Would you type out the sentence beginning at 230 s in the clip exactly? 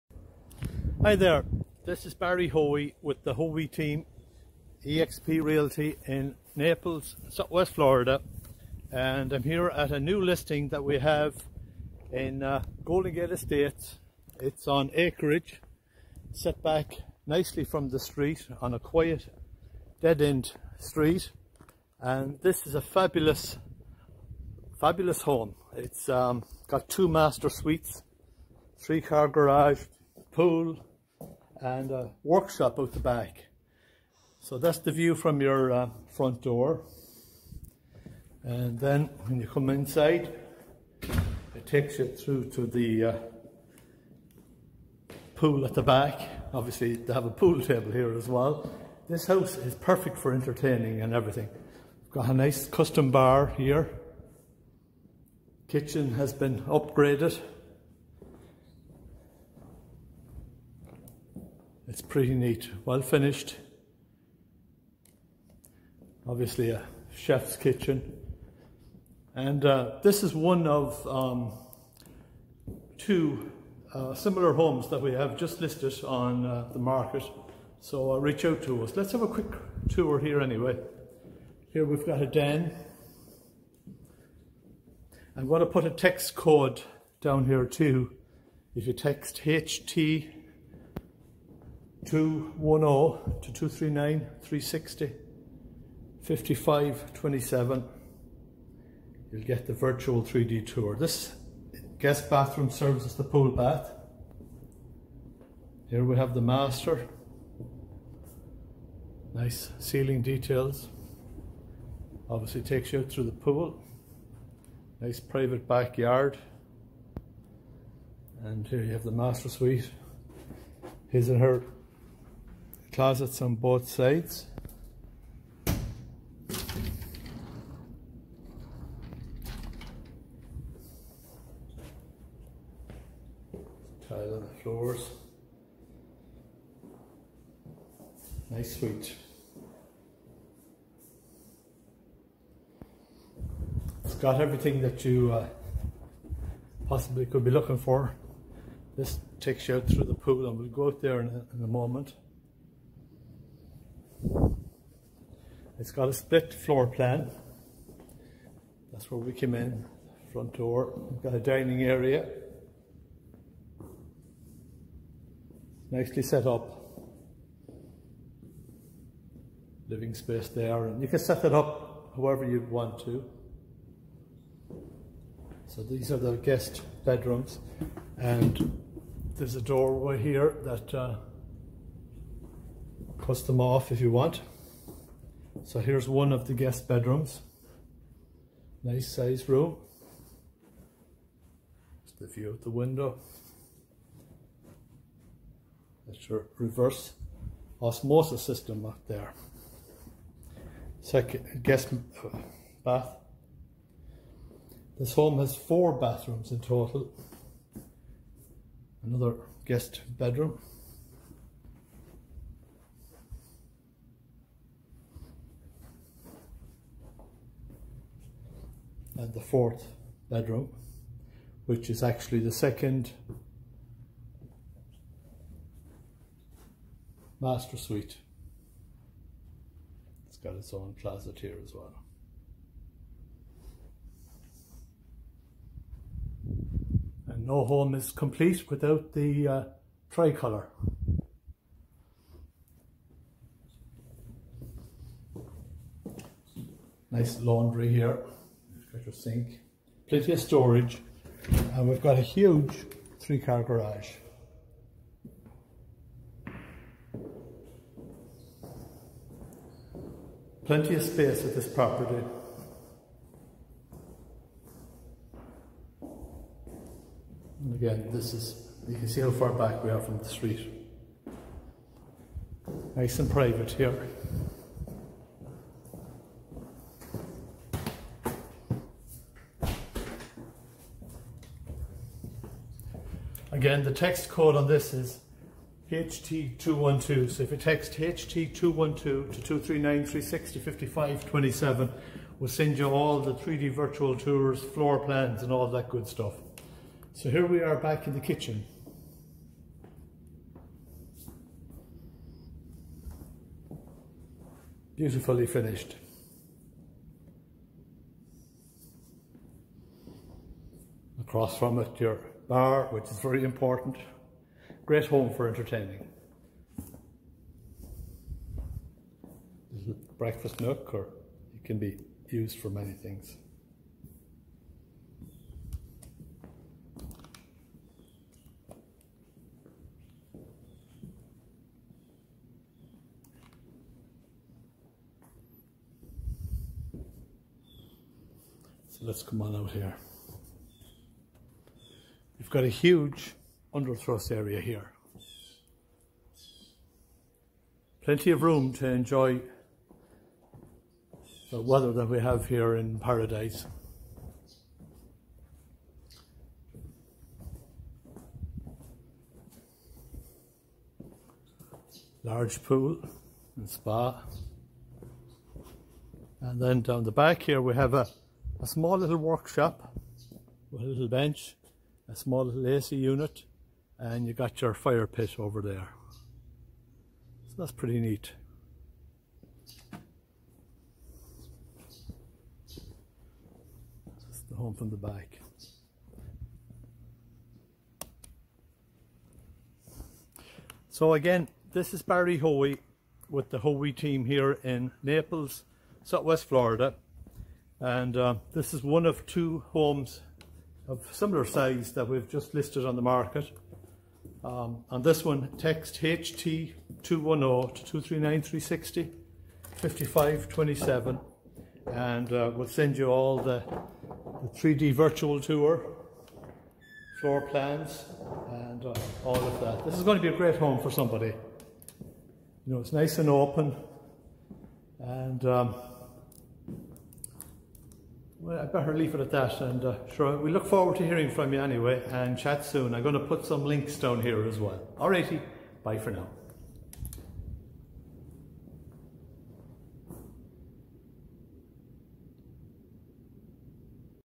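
It's got its own closet here as well.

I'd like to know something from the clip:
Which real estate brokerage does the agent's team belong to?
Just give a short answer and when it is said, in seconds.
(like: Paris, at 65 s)
EXP Realty, at 4 s.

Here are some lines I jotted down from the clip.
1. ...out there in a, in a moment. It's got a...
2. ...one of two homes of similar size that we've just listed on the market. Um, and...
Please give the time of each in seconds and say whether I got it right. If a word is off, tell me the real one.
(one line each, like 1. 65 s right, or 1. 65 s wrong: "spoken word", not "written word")
1. 150 s right
2. 398 s right.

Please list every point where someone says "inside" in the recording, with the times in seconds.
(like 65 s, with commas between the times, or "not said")
39 s.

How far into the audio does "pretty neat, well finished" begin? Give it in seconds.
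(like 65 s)
62 s.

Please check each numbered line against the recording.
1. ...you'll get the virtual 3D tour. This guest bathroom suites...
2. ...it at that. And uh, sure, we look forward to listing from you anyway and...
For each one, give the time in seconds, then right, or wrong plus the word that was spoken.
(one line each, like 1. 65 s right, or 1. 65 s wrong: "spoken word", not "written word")
1. 99 s wrong: "serves", not "suites"
2. 429 s wrong: "hearing", not "listing".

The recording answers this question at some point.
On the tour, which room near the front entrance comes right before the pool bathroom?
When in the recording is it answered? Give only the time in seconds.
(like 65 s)
82 s.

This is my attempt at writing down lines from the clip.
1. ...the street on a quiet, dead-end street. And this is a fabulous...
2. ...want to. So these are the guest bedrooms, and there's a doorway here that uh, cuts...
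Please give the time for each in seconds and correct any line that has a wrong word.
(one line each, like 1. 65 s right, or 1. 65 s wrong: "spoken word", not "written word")
1. 17 s right
2. 172 s right.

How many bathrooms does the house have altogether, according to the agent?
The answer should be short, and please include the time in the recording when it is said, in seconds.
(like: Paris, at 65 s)
4, at 205 s.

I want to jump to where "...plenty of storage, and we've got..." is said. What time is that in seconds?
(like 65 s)
250 s.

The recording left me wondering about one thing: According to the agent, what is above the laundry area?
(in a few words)
Tricolour.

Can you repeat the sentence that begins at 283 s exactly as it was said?
Again, the text code on this is HT212.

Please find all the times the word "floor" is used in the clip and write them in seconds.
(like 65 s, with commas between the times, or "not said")
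134 s, 156 s, 294 s, 417 s.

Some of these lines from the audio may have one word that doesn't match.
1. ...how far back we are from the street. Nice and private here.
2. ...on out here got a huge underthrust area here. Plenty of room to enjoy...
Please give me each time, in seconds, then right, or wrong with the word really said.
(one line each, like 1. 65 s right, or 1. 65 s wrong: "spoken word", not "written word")
1. 269 s right
2. 339 s right.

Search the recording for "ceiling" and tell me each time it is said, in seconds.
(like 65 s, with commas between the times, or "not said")
109 s.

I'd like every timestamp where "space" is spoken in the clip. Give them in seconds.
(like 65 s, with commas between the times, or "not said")
170 s, 261 s.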